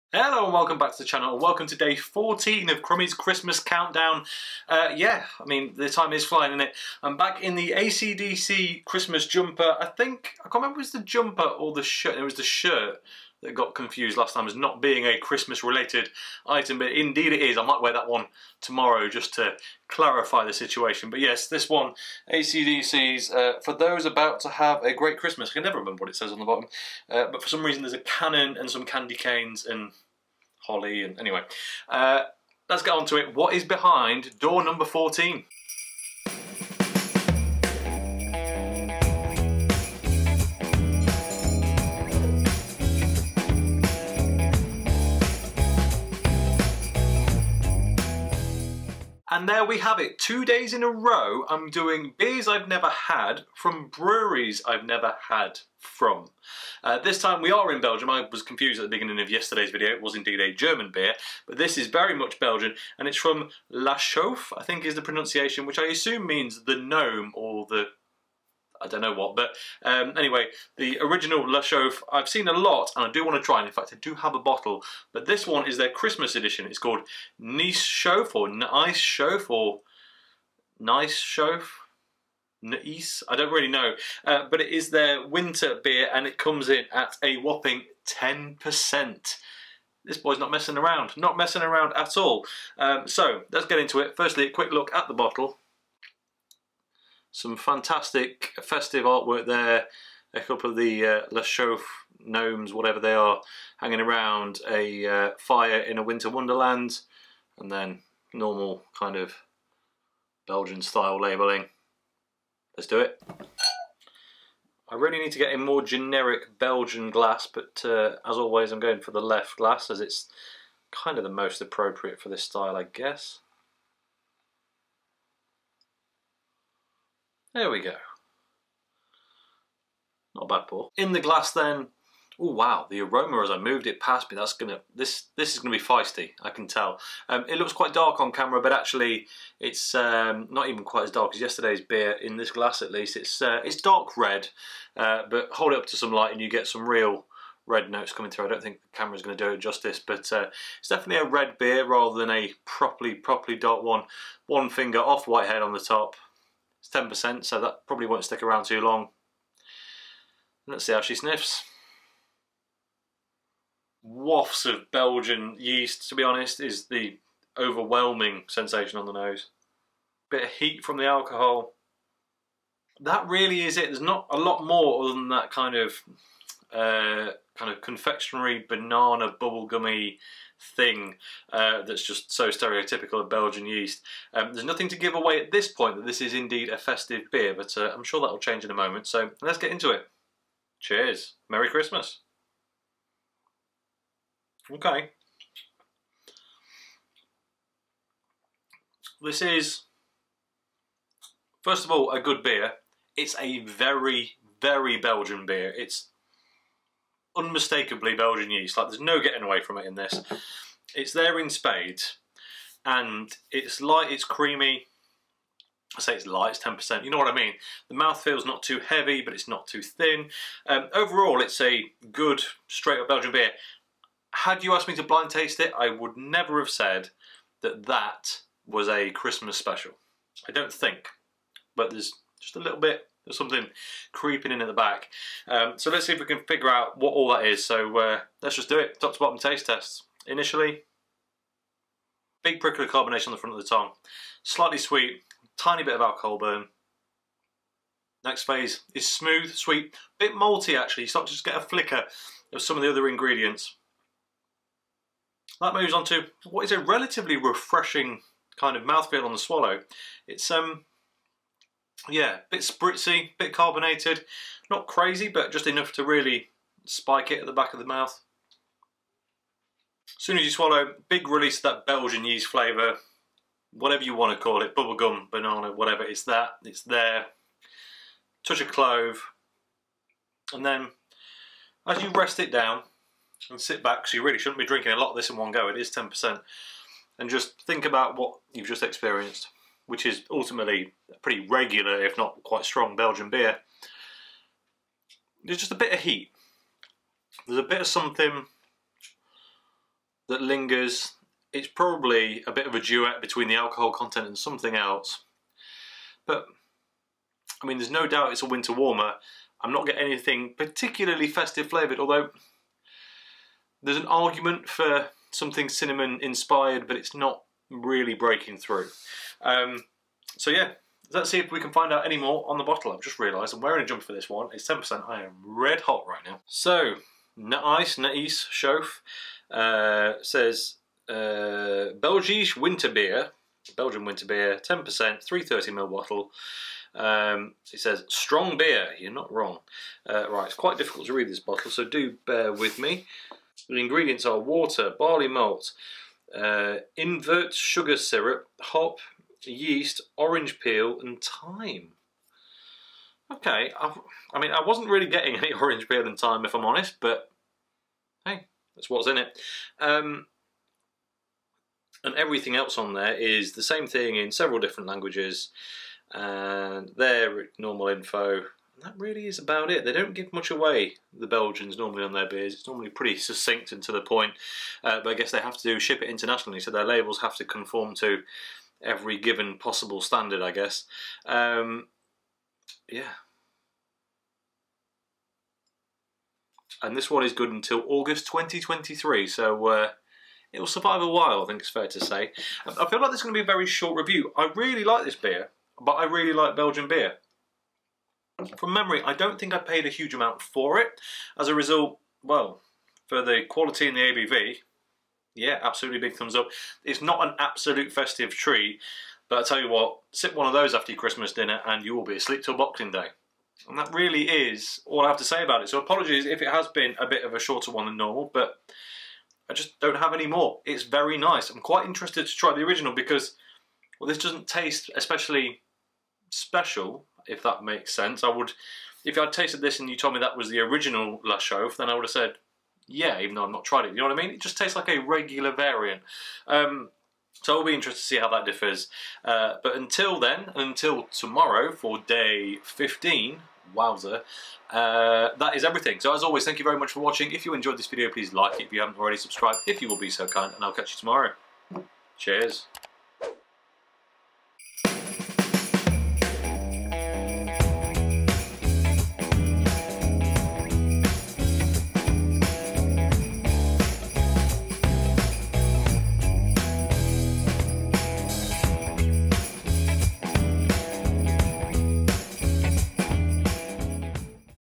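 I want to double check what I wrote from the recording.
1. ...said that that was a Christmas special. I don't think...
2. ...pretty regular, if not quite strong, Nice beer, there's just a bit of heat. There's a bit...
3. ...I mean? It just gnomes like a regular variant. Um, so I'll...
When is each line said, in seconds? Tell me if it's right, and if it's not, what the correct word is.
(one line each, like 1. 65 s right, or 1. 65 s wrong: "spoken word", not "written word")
1. 226 s right
2. 291 s wrong: "Belgian", not "Nice"
3. 434 s wrong: "tastes", not "gnomes".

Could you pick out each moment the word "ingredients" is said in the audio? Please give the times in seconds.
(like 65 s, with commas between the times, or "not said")
253 s, 343 s.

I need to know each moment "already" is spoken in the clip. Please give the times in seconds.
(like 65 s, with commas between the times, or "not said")
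448 s.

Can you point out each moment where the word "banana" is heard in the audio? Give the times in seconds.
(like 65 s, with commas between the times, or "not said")
178 s, 275 s.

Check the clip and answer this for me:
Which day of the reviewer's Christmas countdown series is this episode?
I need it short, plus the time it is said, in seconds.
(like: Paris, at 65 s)
14, at 1 s.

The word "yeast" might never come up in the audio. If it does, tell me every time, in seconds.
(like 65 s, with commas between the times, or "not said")
165 s, 183 s, 208 s, 272 s, 349 s.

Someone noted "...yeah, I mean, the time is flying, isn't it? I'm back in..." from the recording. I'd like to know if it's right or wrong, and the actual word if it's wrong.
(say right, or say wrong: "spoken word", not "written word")
right.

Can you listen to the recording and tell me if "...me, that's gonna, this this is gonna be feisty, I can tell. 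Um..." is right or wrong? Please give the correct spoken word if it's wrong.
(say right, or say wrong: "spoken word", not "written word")
right.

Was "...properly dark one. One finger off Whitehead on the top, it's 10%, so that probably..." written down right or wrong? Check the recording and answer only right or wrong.
right.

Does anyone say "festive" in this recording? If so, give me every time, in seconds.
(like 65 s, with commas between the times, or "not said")
98 s, 186 s, 311 s, 407 s.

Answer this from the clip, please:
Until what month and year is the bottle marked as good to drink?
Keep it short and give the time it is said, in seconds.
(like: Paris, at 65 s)
August 2023, at 387 s.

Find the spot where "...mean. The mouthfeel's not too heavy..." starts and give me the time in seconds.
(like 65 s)
217 s.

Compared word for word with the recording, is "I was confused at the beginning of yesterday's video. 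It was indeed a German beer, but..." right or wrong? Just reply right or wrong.
right.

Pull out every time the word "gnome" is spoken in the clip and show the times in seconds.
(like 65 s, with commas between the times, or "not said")
66 s, 102 s.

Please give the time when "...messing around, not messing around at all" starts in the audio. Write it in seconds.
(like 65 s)
90 s.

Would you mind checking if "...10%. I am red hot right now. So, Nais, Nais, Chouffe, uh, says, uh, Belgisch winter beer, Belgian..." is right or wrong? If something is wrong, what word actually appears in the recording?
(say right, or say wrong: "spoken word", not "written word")
right.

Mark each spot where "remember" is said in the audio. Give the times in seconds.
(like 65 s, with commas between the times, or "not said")
10 s, 25 s.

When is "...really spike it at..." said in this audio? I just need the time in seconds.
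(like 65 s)
266 s.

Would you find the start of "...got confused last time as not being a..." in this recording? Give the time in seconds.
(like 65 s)
13 s.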